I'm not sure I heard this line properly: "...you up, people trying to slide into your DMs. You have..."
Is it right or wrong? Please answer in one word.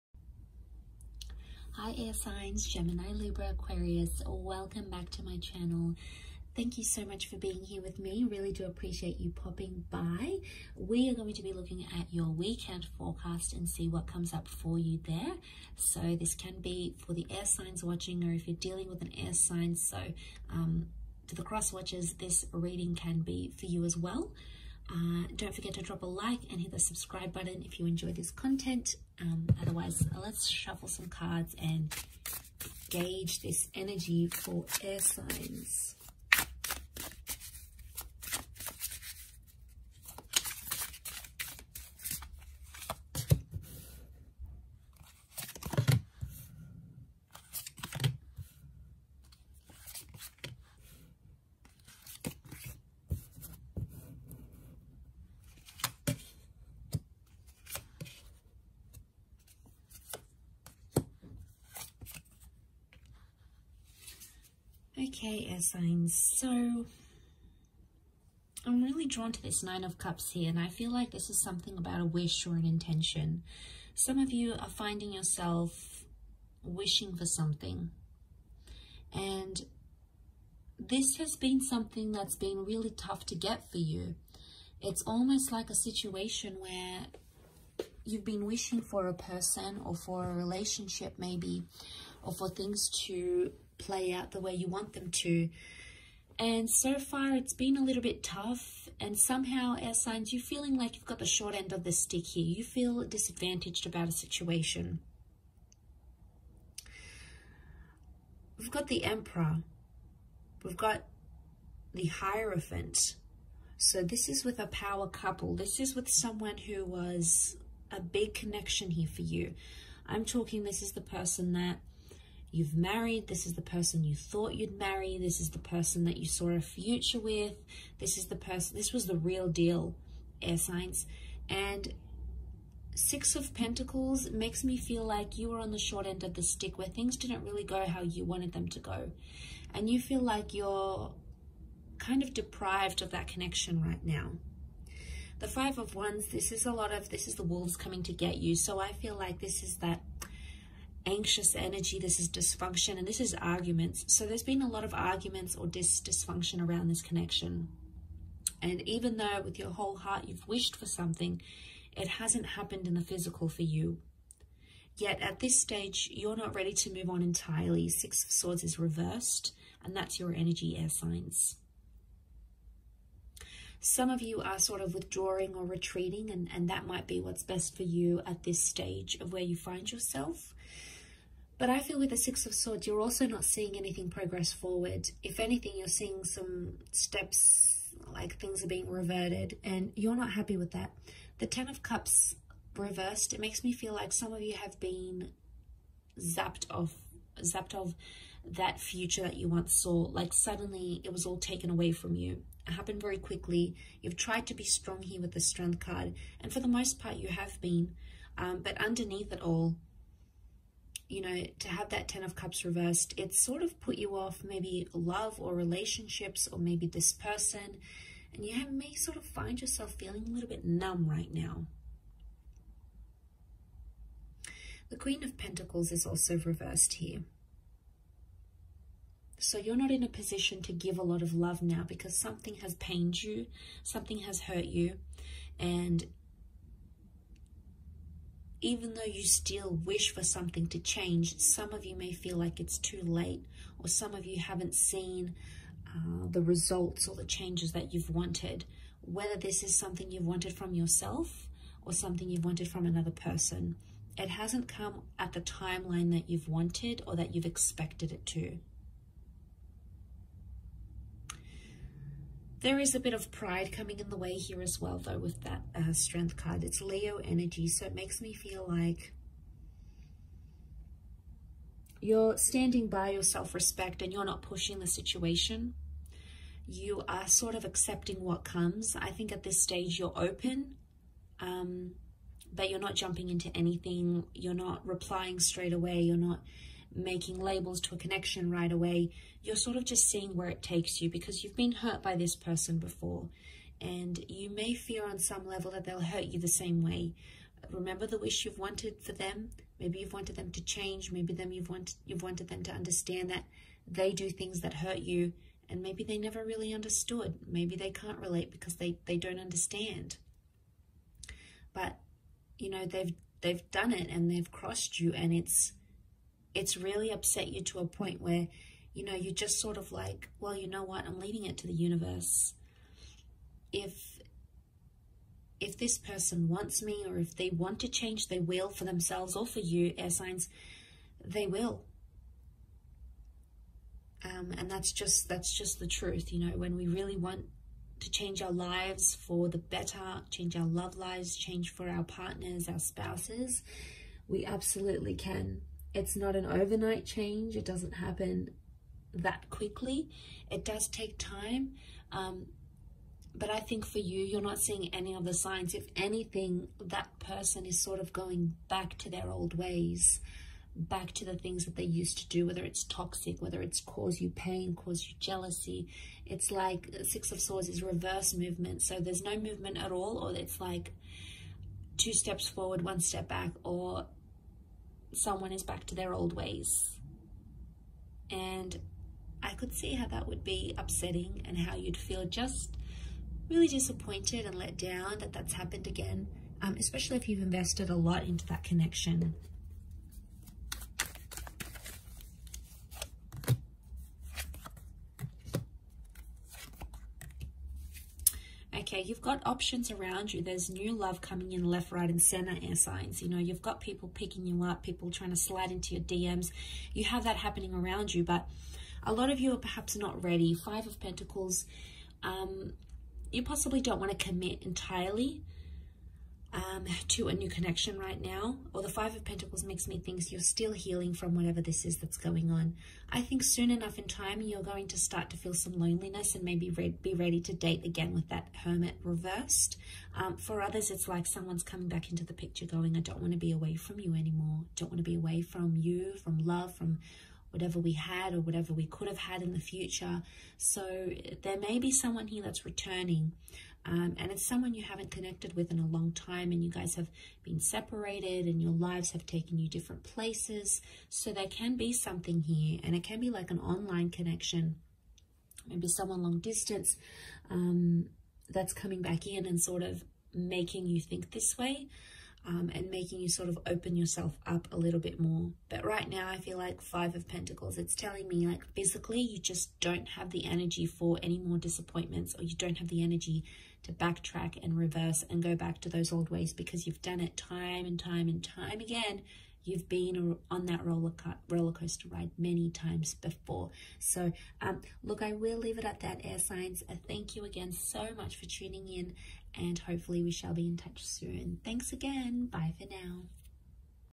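right.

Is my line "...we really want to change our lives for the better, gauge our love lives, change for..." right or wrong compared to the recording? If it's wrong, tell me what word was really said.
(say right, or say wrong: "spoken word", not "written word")
wrong: "change", not "gauge".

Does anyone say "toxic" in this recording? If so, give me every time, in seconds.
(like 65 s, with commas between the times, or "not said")
362 s.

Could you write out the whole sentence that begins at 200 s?
Like suddenly it was all taken away from you.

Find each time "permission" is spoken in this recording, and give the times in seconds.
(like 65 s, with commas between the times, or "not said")
not said.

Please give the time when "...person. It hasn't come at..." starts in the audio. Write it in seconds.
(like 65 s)
253 s.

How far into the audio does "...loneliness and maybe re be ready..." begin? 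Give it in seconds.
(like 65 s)
425 s.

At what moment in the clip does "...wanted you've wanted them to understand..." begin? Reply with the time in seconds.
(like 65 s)
301 s.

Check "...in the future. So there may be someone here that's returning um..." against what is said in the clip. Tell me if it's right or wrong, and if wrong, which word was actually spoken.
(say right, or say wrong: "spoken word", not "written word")
right.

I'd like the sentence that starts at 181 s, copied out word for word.
But I feel with the Six of Swords, you're also not seeing anything progress forward.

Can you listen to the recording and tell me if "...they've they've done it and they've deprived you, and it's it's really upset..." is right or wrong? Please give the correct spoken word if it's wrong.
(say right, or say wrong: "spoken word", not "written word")
wrong: "crossed", not "deprived".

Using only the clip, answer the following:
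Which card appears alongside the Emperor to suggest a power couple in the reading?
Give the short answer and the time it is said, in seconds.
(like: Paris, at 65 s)
The Hierophant, at 112 s.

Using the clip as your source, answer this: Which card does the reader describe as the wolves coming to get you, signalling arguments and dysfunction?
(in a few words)
Five of Wands.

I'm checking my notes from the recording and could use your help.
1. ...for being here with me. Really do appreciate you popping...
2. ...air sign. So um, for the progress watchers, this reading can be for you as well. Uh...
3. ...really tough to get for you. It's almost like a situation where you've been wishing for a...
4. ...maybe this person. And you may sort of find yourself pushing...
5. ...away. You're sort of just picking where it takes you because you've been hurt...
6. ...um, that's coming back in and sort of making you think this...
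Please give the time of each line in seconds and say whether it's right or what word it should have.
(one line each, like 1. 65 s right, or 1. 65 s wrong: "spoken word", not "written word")
1. 7 s right
2. 19 s wrong: "cross", not "progress"
3. 82 s right
4. 216 s wrong: "feeling", not "pushing"
5. 288 s wrong: "seeing", not "picking"
6. 457 s right.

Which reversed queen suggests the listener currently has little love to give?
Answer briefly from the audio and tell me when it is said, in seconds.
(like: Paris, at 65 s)
Queen of Pentacles, at 224 s.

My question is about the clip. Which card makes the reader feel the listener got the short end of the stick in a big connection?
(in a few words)
Six of Pentacles.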